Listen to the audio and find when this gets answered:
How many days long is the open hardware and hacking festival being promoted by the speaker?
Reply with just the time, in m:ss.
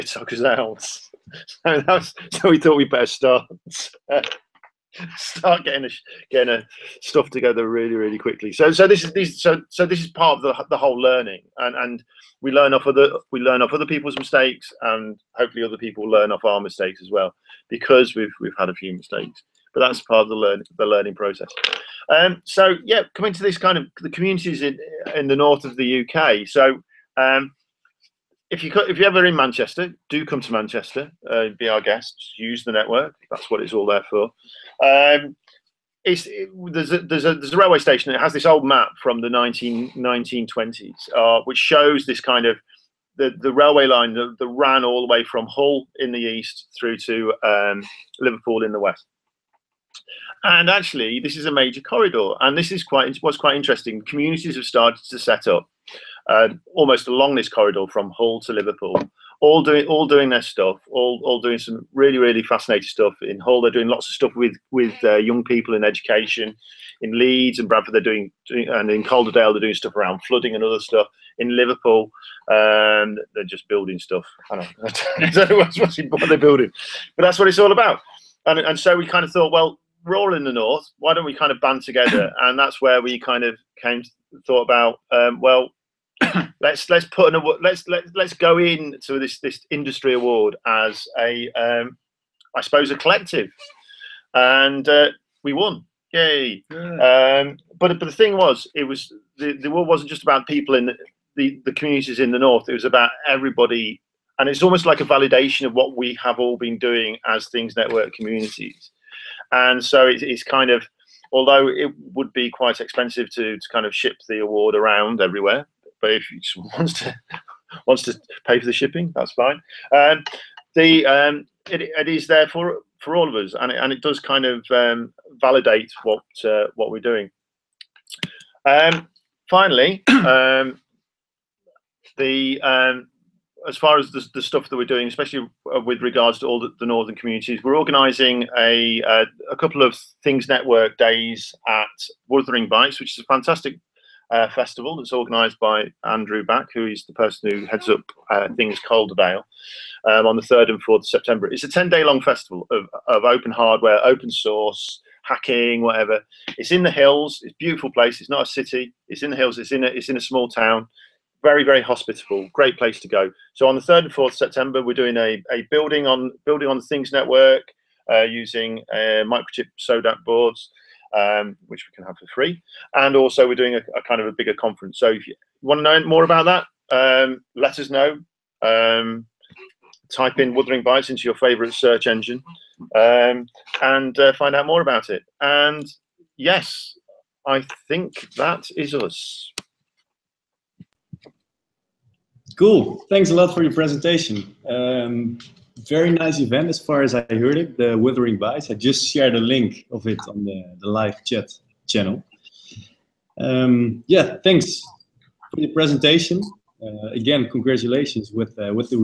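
2:31.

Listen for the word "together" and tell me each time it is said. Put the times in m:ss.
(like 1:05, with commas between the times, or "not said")
0:07, 1:21.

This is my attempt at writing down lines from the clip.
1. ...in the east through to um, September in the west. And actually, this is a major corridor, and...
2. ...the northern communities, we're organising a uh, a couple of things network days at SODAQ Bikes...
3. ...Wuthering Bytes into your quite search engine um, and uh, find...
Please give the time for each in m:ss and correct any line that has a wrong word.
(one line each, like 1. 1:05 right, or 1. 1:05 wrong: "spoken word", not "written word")
1. 0:45 wrong: "Liverpool", not "September"
2. 2:16 wrong: "Wuthering", not "SODAQ"
3. 3:00 wrong: "favorite", not "quite".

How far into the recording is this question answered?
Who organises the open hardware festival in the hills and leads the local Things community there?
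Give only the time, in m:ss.
2:26.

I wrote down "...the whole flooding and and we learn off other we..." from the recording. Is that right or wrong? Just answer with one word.
wrong.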